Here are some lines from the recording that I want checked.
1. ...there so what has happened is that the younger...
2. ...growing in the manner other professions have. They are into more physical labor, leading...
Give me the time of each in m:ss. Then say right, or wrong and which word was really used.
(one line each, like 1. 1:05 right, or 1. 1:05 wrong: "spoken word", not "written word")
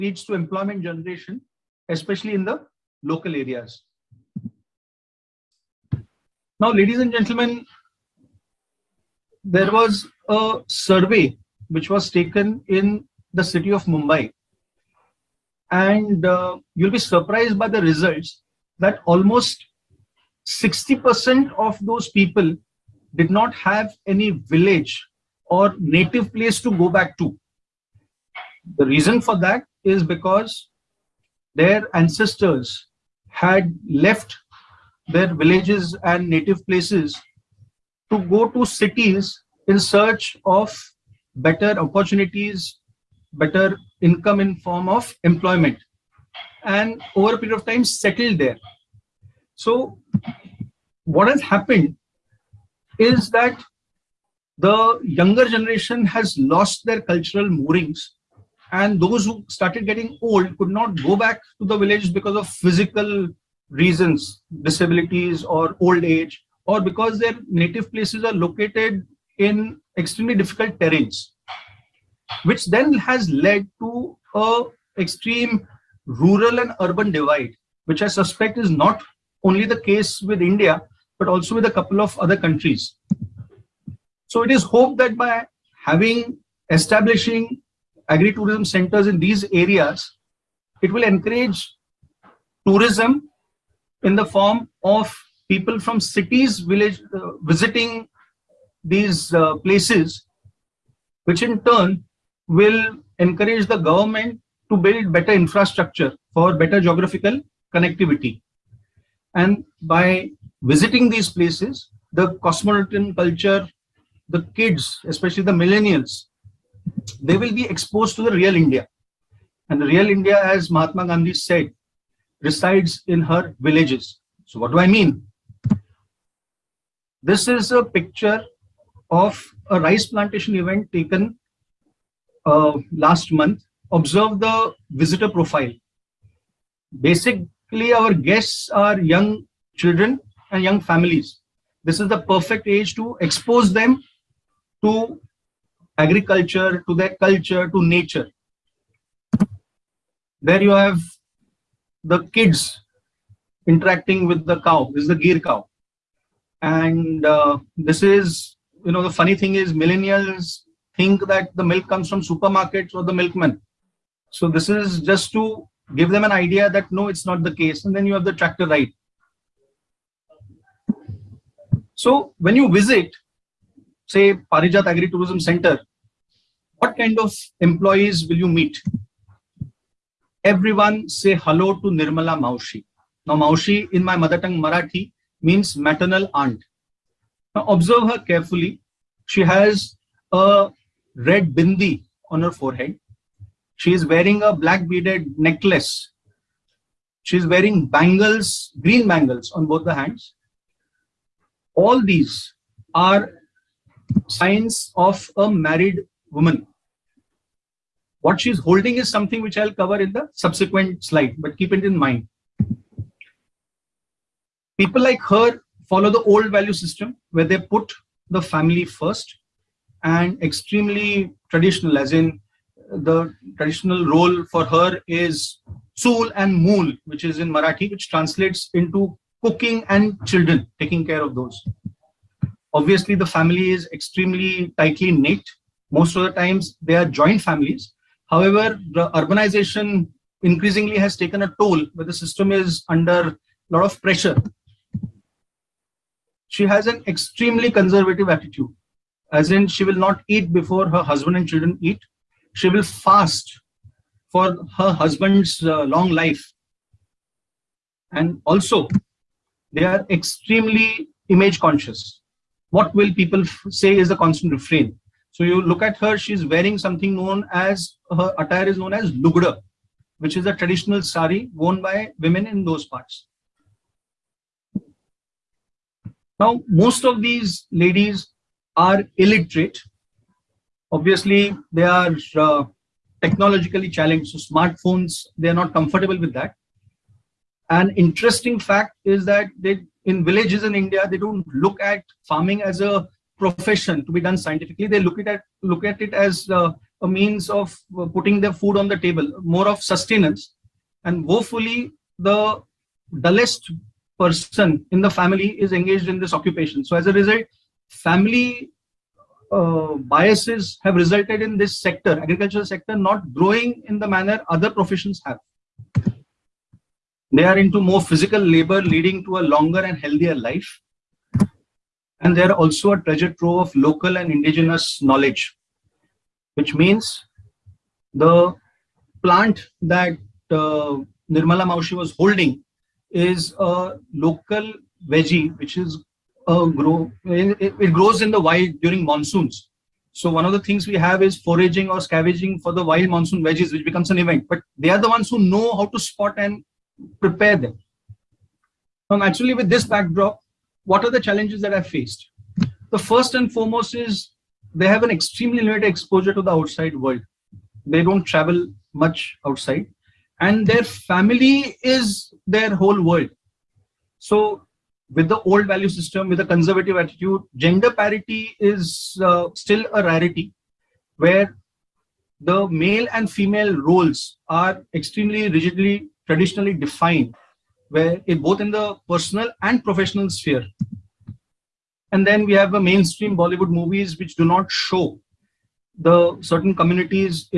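1. 0:48 right
2. 5:13 right.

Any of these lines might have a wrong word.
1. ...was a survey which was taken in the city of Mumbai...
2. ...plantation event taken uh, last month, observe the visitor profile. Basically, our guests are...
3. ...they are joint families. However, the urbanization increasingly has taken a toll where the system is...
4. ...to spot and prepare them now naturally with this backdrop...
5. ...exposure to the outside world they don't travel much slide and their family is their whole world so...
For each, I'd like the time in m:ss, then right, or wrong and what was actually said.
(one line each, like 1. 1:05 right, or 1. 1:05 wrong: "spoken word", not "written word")
1. 0:09 right
2. 2:10 right
3. 3:56 right
4. 5:45 right
5. 5:55 wrong: "outside", not "slide".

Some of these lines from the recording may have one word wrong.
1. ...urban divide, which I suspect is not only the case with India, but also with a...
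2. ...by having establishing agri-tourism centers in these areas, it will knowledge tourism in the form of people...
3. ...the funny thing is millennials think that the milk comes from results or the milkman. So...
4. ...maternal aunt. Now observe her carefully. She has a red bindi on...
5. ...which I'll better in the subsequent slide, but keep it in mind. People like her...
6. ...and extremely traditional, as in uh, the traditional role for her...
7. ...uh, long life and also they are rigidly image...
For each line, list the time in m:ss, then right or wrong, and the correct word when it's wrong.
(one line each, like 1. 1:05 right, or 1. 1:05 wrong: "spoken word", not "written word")
1. 1:16 right
2. 1:25 wrong: "encourage", not "knowledge"
3. 2:39 wrong: "supermarkets", not "results"
4. 3:05 right
5. 3:29 wrong: "cover", not "better"
6. 3:40 right
7. 4:15 wrong: "extremely", not "rigidly".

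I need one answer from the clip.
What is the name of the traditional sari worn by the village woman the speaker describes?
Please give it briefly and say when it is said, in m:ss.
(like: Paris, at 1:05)
Lugda, at 4:29.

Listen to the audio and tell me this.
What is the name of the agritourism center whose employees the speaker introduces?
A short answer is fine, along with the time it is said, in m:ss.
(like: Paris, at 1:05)
Parijat, at 2:54.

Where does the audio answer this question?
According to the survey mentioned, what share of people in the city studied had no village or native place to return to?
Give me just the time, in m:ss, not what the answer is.
0:20.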